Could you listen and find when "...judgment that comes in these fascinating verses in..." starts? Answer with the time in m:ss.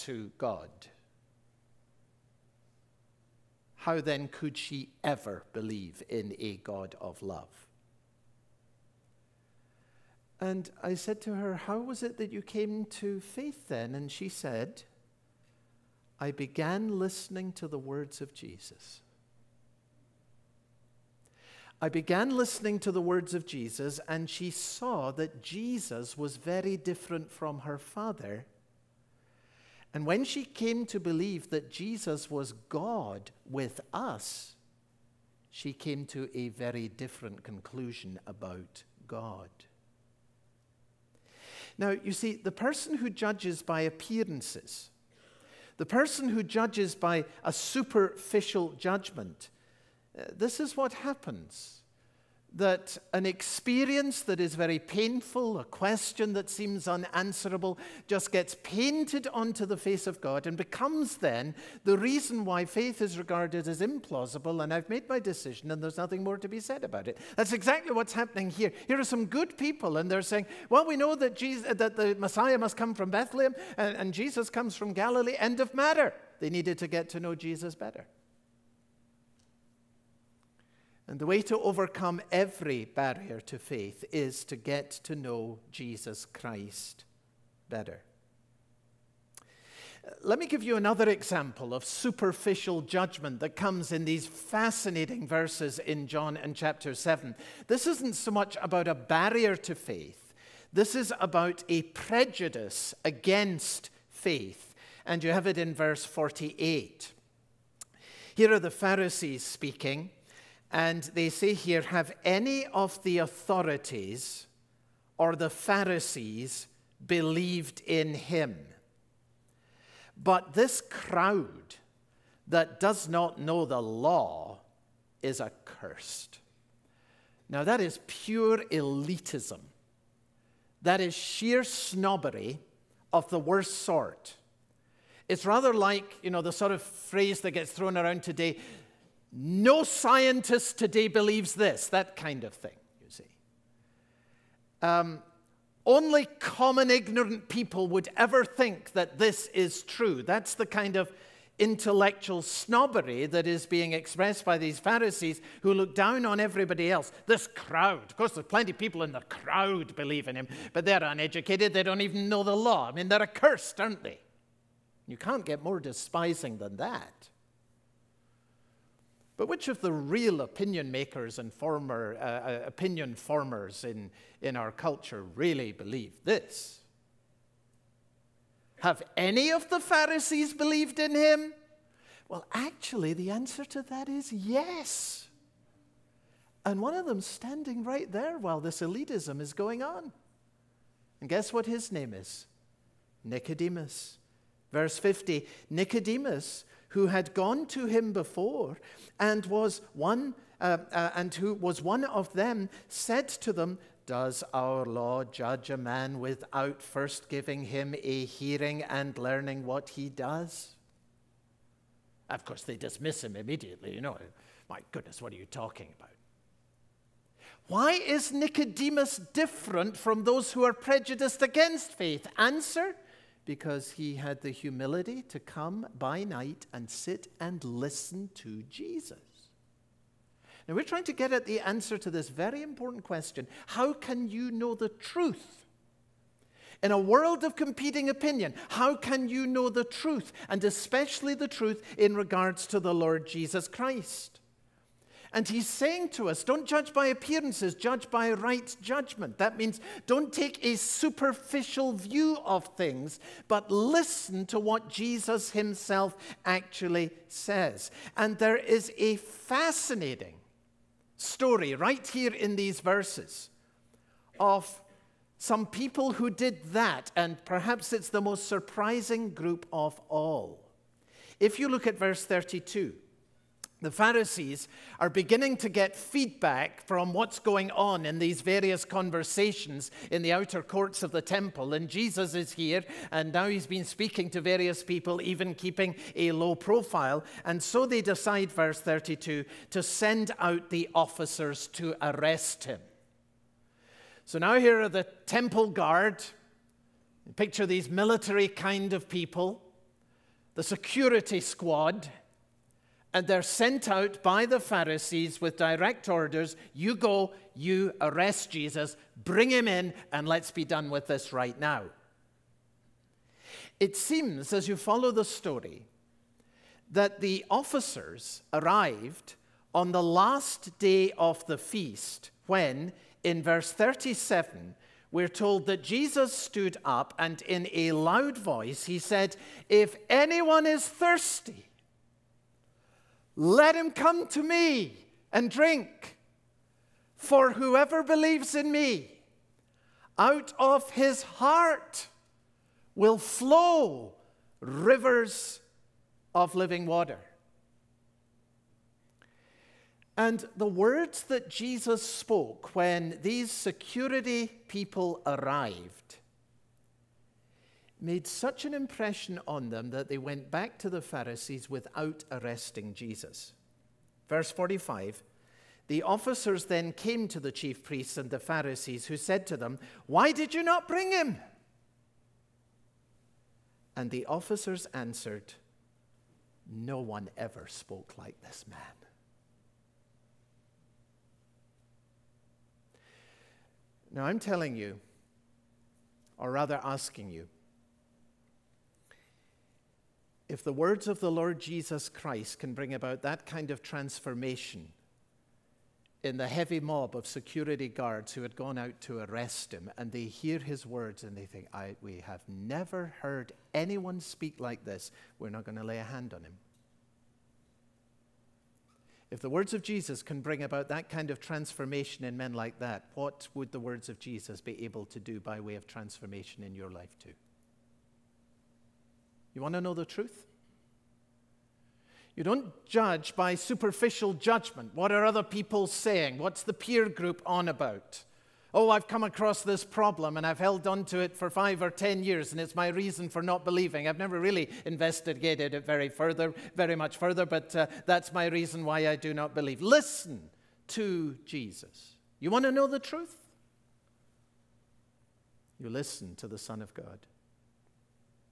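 1:32.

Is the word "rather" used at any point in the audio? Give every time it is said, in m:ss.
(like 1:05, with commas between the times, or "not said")
2:15, 6:26.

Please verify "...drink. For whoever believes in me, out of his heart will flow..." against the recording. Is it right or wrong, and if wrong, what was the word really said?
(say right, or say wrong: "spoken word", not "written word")
right.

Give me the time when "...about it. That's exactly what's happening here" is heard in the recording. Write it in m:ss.
1:06.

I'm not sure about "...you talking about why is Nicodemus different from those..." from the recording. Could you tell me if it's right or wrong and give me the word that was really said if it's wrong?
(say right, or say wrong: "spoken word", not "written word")
right.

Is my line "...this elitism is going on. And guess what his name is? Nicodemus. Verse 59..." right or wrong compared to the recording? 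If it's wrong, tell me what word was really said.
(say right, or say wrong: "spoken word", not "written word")
wrong: "50", not "59".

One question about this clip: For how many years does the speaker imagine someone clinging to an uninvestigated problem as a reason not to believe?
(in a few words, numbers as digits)
5 or 10 years.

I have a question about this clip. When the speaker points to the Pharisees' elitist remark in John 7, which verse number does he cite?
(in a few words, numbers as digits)
48.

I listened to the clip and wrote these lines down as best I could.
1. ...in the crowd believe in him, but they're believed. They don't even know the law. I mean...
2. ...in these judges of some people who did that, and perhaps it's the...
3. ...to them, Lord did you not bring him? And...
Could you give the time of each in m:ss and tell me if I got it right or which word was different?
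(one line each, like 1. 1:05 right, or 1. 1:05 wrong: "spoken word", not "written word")
1. 2:39 wrong: "uneducated", not "believed"
2. 4:22 wrong: "verses", not "judges"
3. 6:09 wrong: "Why", not "Lord".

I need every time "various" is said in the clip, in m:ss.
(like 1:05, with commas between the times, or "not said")
4:38, 4:44.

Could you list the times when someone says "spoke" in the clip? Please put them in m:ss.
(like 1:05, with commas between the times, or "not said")
5:52, 6:17.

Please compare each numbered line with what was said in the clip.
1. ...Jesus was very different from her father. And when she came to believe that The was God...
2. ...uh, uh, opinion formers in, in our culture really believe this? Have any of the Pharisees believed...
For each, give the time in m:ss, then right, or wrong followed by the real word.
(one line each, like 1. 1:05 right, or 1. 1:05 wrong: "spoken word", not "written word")
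1. 0:25 wrong: "Jesus", not "The"
2. 2:52 right.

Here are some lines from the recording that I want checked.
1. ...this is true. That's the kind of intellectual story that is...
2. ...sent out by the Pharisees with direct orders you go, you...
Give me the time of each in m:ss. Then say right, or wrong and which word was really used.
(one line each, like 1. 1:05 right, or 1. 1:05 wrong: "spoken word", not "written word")
1. 2:29 wrong: "snobbery", not "story"
2. 5:03 right.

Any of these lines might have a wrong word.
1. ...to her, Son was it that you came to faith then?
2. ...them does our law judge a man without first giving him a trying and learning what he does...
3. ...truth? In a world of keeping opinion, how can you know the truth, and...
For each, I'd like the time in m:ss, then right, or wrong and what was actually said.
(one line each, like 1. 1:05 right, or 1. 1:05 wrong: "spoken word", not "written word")
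1. 0:11 wrong: "How", not "Son"
2. 3:23 wrong: "hearing", not "trying"
3. 3:54 wrong: "competing", not "keeping".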